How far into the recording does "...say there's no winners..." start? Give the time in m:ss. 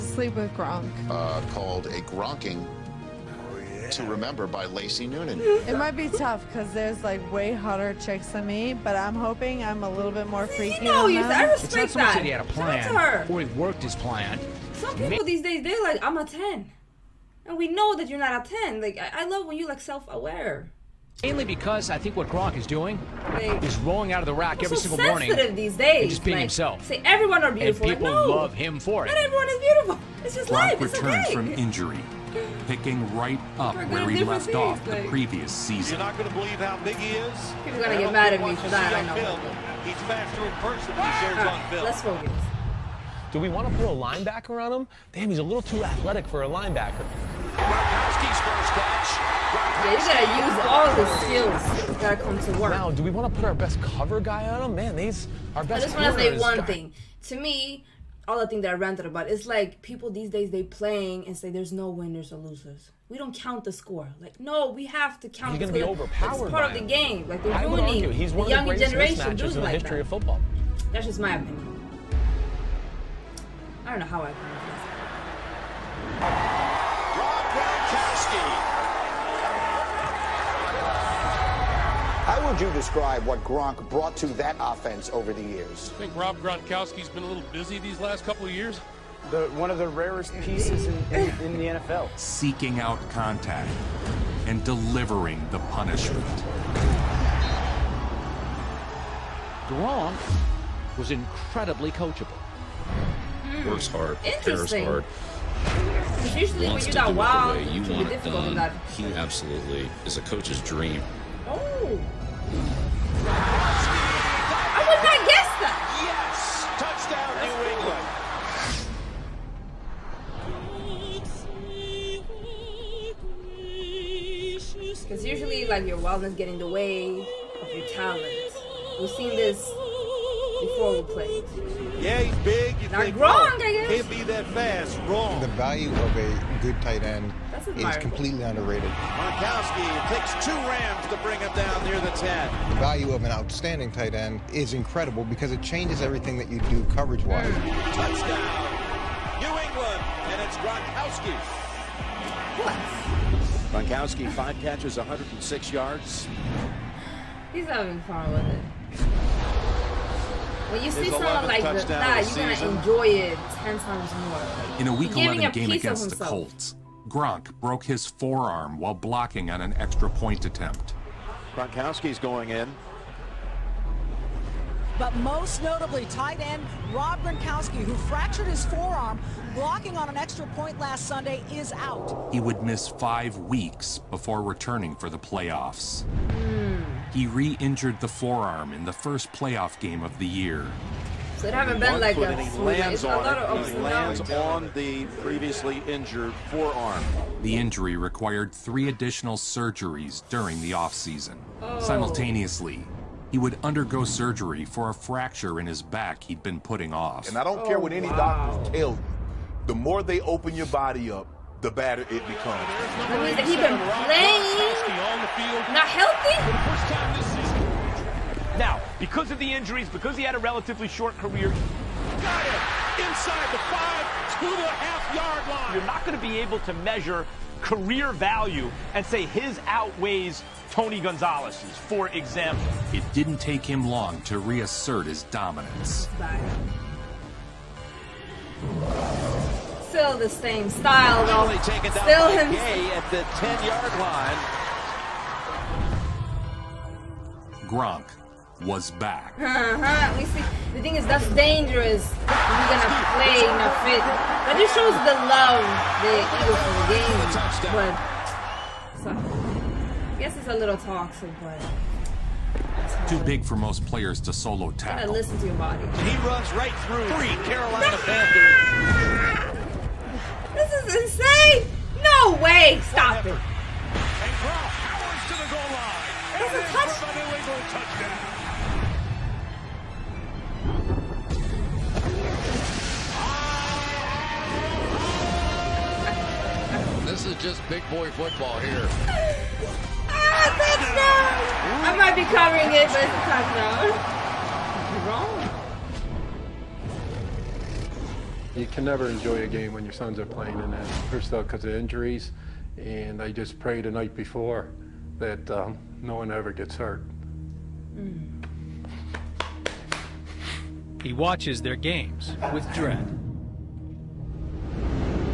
1:01.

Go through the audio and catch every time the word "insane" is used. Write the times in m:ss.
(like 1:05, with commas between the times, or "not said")
4:30.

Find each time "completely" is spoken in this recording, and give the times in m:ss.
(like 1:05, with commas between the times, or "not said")
2:17.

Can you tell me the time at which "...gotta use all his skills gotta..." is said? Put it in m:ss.
0:49.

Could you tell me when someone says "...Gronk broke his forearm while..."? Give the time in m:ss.
2:47.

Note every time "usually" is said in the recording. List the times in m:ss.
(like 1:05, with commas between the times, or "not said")
1:46, 2:05.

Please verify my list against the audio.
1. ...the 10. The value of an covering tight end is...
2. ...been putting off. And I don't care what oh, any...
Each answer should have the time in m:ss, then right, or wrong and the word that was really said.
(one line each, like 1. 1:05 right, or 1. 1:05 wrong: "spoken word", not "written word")
1. 2:21 wrong: "outstanding", not "covering"
2. 3:26 right.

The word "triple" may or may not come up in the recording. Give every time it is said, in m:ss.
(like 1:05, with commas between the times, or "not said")
not said.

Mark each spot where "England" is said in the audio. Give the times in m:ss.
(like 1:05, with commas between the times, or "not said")
1:57, 2:29.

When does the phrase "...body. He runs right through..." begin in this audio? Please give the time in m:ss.
4:25.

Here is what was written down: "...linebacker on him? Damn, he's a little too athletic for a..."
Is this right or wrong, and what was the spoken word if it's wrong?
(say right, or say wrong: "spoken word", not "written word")
right.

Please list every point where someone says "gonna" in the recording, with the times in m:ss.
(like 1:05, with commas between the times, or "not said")
1:05, 2:42, 4:12.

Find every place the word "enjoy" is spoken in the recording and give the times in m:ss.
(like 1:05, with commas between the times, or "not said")
2:42, 4:59.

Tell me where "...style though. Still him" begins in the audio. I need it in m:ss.
4:00.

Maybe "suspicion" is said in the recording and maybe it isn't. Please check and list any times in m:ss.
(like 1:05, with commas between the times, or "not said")
not said.